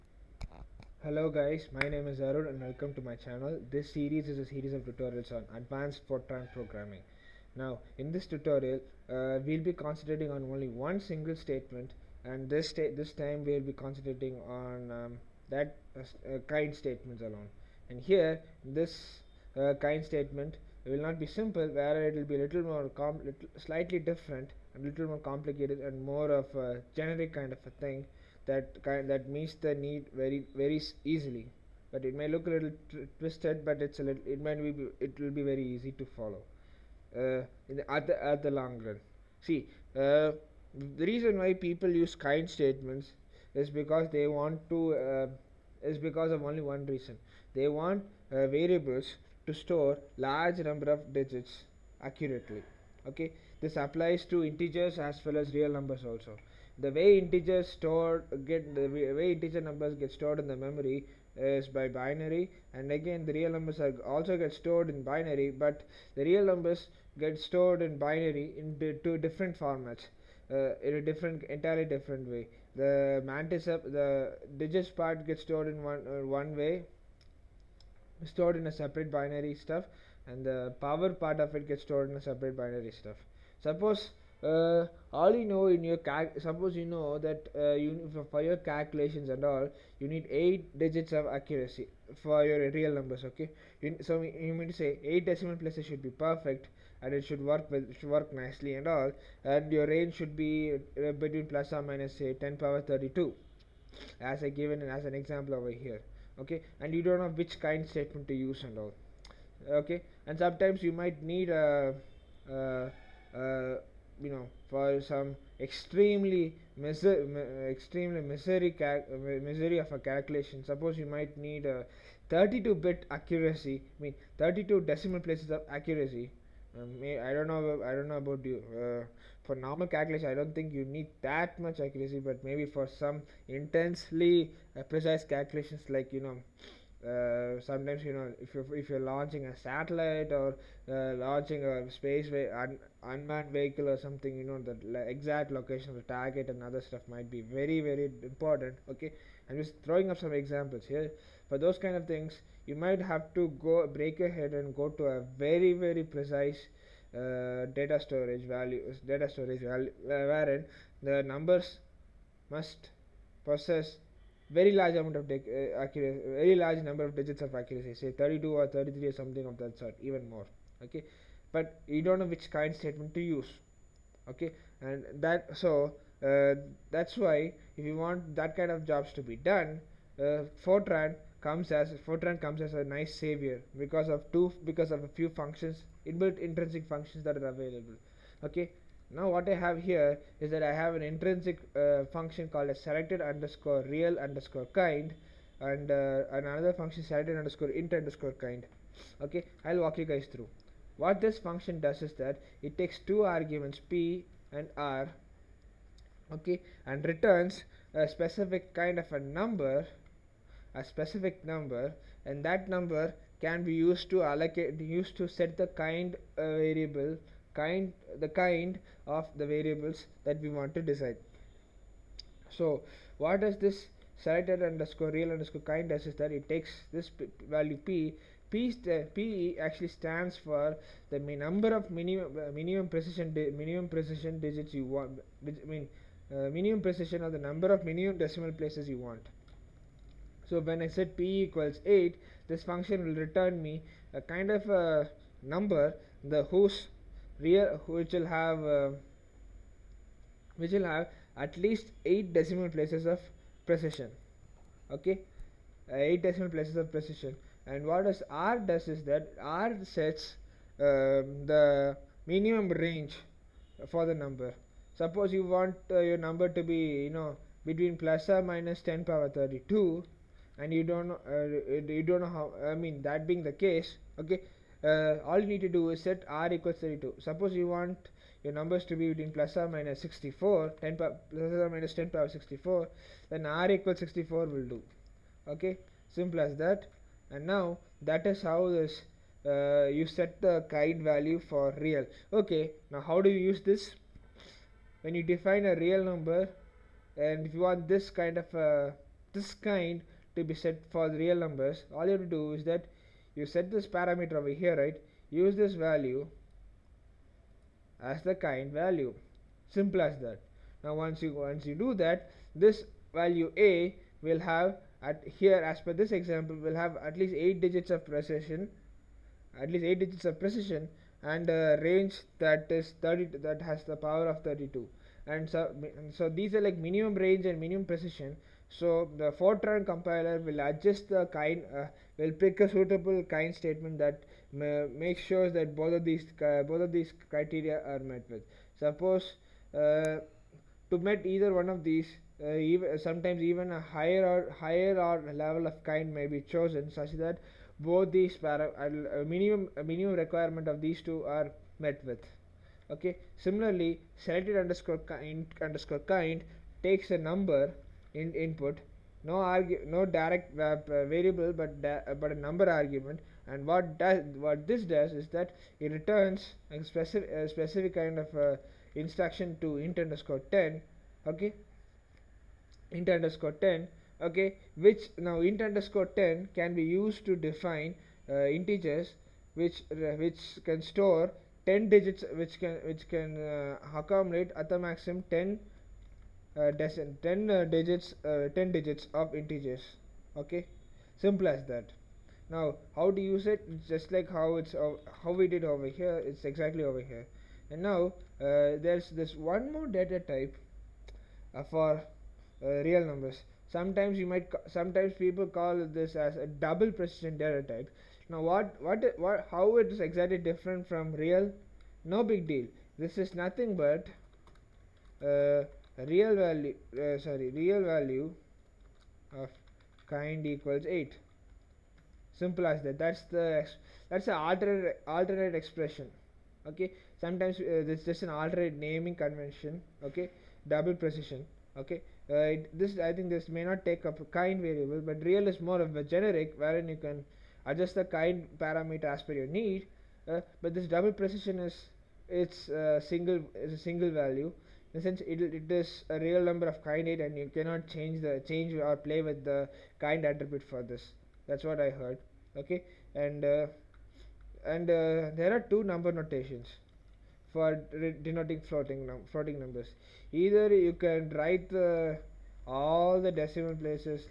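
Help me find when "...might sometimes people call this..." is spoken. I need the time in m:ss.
6:44.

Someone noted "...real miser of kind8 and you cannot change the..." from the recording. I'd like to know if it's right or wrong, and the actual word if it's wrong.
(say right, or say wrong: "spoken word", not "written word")
wrong: "number", not "miser".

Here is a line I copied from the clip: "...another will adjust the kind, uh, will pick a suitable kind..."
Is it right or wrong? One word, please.
wrong.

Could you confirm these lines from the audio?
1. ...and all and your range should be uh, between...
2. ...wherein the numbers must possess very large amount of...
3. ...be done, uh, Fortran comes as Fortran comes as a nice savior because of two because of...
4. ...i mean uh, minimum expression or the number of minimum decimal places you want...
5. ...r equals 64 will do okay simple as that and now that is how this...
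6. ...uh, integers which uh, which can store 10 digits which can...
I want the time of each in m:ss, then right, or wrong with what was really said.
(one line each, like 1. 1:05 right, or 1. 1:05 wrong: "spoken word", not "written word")
1. 1:38 right
2. 2:40 right
3. 2:59 right
4. 3:55 wrong: "precision", not "expression"
5. 4:43 right
6. 6:18 right.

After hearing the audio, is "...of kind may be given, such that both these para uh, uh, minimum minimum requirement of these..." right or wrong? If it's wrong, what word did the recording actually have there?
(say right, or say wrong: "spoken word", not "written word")
wrong: "chosen", not "given".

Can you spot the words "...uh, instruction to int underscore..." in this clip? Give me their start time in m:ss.
6:08.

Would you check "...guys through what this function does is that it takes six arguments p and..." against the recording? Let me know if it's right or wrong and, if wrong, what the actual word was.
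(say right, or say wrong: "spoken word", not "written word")
wrong: "two", not "six".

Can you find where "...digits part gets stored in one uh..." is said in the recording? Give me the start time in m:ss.
1:14.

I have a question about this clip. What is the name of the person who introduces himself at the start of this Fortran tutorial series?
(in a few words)
Arun.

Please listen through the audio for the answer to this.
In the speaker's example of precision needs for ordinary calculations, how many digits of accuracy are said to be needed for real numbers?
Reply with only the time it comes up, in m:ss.
1:30.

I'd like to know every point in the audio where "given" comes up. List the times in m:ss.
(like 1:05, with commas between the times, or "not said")
1:44.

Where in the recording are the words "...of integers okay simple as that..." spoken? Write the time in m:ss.
6:29.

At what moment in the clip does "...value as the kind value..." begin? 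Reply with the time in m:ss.
5:05.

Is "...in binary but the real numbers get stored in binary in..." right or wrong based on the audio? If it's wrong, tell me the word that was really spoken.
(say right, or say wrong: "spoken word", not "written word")
right.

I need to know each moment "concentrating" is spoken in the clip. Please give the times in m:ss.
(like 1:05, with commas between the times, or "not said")
0:09, 0:13.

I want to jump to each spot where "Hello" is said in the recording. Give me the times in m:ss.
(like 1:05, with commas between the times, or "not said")
0:01.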